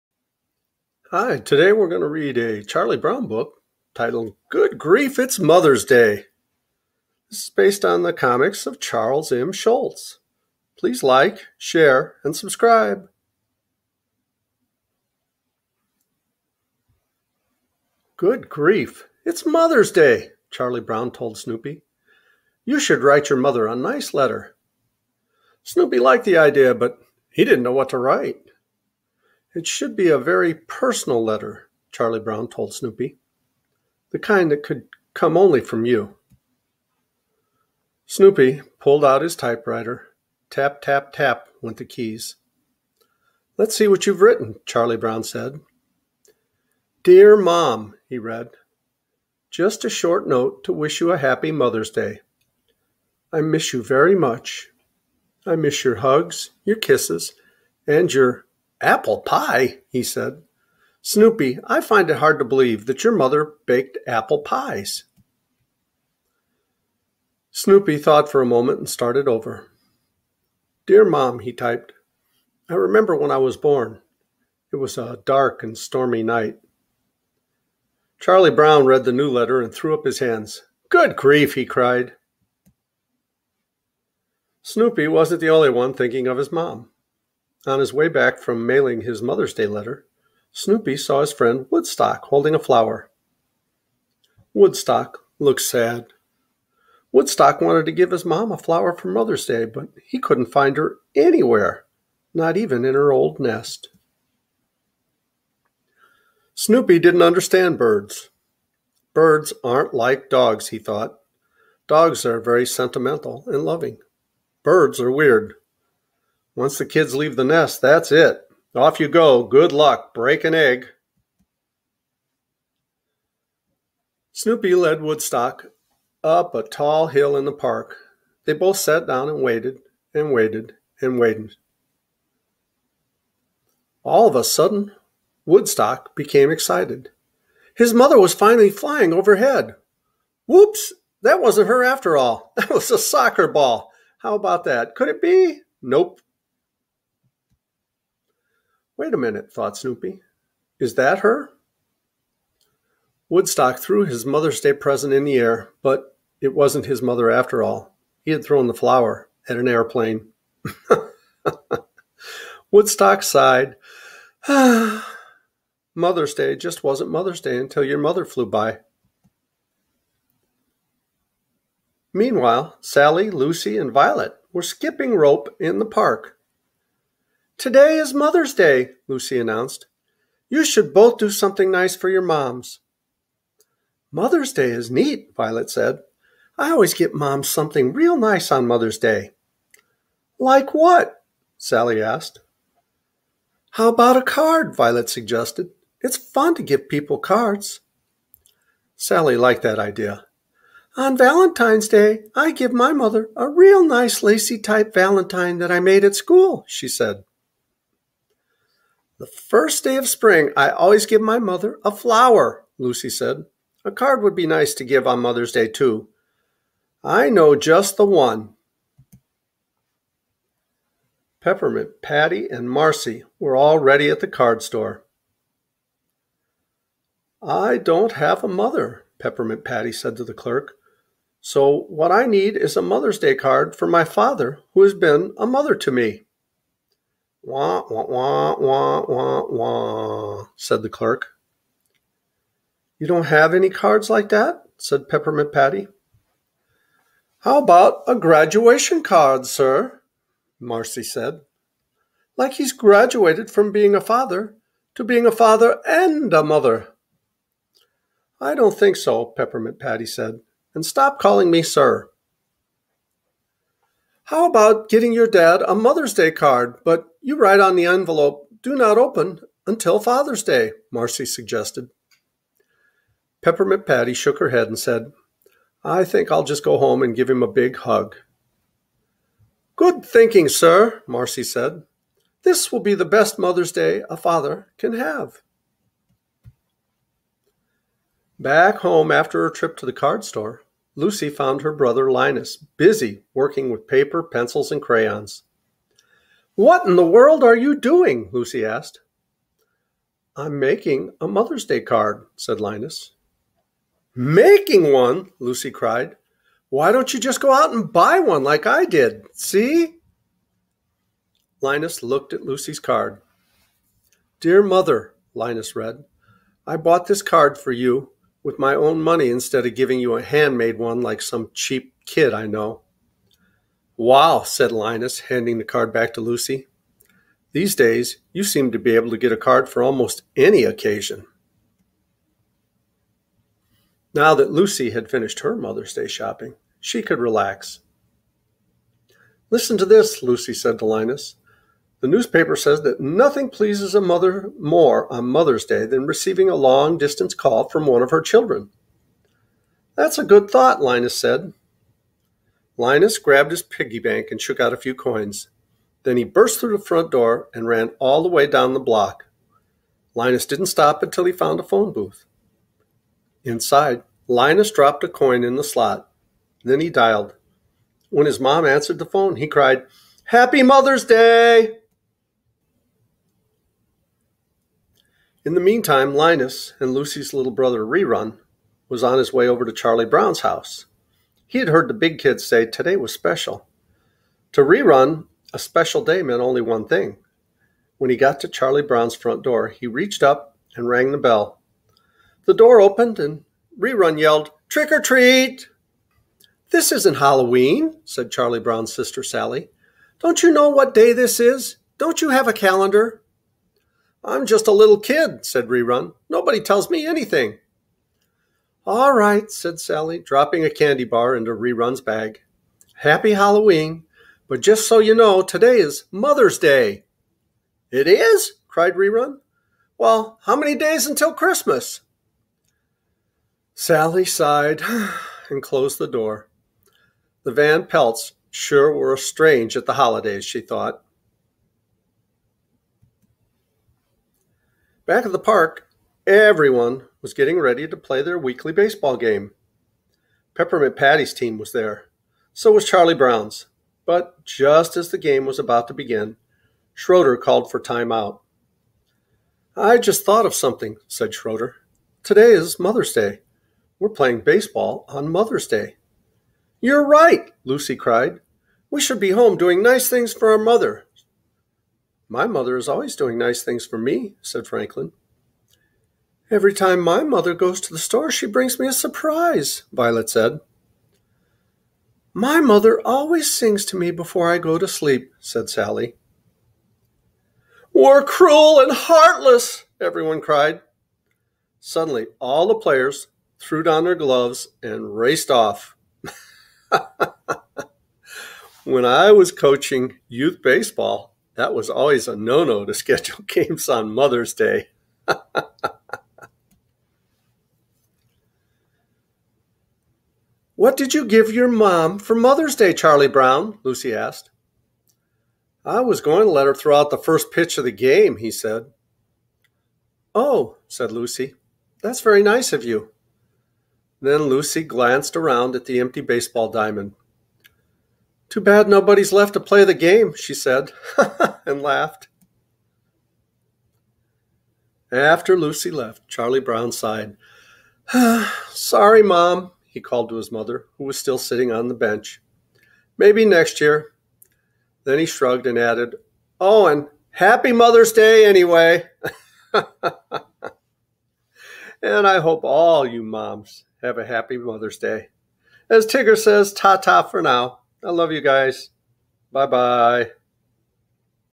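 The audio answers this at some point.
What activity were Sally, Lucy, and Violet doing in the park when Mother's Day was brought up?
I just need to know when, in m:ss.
2:54.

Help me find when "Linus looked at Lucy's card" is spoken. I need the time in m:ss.
5:11.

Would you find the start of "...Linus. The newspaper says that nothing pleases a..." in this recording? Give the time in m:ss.
5:40.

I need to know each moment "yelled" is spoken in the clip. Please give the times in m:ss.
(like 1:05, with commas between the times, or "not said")
6:34.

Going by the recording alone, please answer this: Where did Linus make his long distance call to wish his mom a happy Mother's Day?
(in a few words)
A phone booth.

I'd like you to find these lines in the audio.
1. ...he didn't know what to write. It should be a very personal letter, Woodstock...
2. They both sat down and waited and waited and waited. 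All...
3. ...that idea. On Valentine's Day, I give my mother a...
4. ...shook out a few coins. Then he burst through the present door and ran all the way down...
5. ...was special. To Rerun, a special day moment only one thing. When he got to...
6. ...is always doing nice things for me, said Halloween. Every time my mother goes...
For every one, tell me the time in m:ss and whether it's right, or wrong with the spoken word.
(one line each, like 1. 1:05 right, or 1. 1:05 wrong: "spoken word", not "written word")
1. 0:27 wrong: "Charlie", not "Woodstock"
2. 2:08 right
3. 3:19 right
4. 5:54 wrong: "front", not "present"
5. 6:22 wrong: "meant", not "moment"
6. 7:42 wrong: "Franklin", not "Halloween".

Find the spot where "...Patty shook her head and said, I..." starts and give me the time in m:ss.
4:33.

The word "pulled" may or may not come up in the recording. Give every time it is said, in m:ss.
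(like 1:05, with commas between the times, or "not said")
0:38.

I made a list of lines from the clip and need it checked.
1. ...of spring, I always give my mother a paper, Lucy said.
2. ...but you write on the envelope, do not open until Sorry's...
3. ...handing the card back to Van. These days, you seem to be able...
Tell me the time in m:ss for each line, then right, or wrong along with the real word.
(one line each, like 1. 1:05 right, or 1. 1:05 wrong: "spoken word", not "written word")
1. 3:29 wrong: "flower", not "paper"
2. 4:26 wrong: "Father", not "Sorry"
3. 5:25 wrong: "Lucy", not "Van".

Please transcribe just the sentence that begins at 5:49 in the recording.
That's a good thought, Linus said.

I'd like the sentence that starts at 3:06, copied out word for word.
I always get Mom something real nice on Mother's Day.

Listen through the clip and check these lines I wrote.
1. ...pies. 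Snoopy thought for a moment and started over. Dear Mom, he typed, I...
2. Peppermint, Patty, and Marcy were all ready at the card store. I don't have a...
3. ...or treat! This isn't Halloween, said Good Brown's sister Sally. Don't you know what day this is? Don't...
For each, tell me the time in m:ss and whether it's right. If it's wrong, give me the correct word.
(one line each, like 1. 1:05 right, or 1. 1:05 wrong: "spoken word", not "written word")
1. 1:04 right
2. 3:41 right
3. 6:34 wrong: "Charlie", not "Good".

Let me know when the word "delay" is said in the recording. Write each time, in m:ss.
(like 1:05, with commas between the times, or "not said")
not said.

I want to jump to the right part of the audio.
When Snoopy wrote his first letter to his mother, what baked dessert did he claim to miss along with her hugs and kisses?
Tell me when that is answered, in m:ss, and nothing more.
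0:58.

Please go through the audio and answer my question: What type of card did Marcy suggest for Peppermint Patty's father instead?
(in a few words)
Graduation card.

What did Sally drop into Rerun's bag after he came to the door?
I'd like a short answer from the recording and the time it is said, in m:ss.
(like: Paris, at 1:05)
A candy bar, at 6:50.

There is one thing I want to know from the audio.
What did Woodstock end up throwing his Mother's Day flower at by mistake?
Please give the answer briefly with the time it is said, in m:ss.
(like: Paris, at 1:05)
An airplane, at 2:39.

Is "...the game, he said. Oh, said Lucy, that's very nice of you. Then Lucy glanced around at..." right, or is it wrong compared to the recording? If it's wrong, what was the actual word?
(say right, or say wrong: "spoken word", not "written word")
right.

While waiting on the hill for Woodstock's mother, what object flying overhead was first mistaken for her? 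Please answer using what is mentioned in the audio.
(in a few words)
A soccer ball.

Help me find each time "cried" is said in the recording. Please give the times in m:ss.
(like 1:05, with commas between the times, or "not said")
1:21, 5:05, 6:09, 6:58, 7:37, 8:00.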